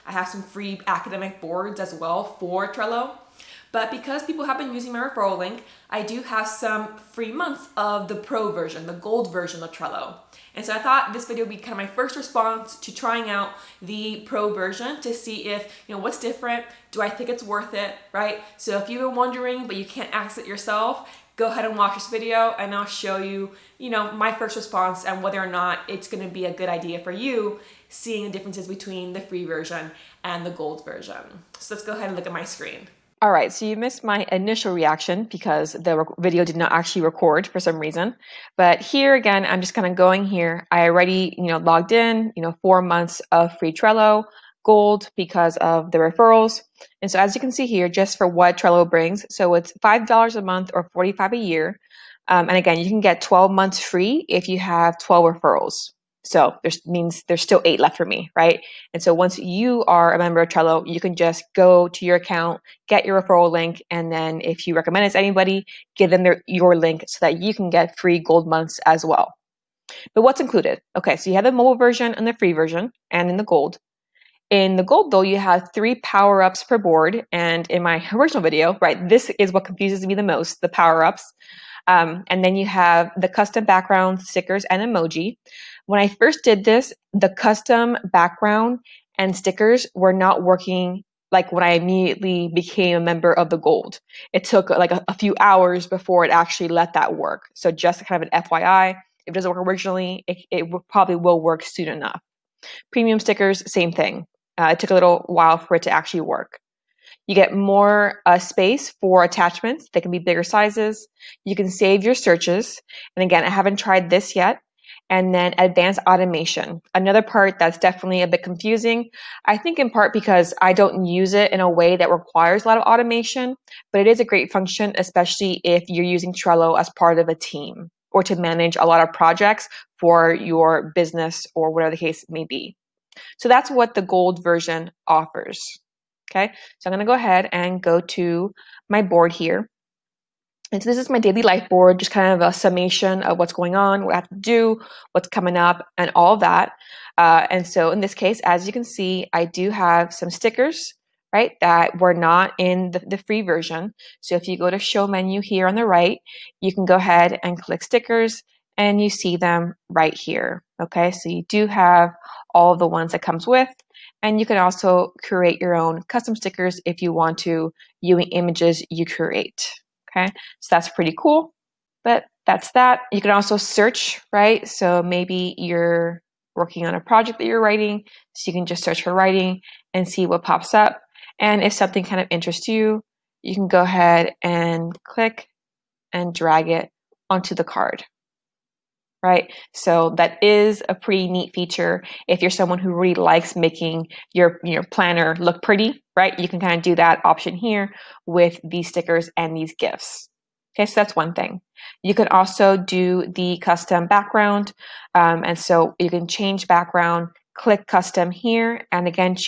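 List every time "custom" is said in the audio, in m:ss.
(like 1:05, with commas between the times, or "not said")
1:23, 1:27, 2:46, 3:23, 3:27.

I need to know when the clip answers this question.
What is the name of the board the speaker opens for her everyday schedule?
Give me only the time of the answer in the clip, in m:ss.
2:21.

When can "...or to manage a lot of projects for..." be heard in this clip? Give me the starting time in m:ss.
2:08.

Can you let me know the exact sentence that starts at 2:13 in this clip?
So that's what the gold version offers.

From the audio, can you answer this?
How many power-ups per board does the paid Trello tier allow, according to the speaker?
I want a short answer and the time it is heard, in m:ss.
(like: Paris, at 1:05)
3, at 1:15.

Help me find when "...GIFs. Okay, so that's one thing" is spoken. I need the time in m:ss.
3:19.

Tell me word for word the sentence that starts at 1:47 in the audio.
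You get more uh, space for attachments.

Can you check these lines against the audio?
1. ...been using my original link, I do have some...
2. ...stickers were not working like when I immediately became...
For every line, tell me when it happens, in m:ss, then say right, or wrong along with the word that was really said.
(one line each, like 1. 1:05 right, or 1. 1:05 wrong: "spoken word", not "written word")
1. 0:04 wrong: "referral", not "original"
2. 1:29 right.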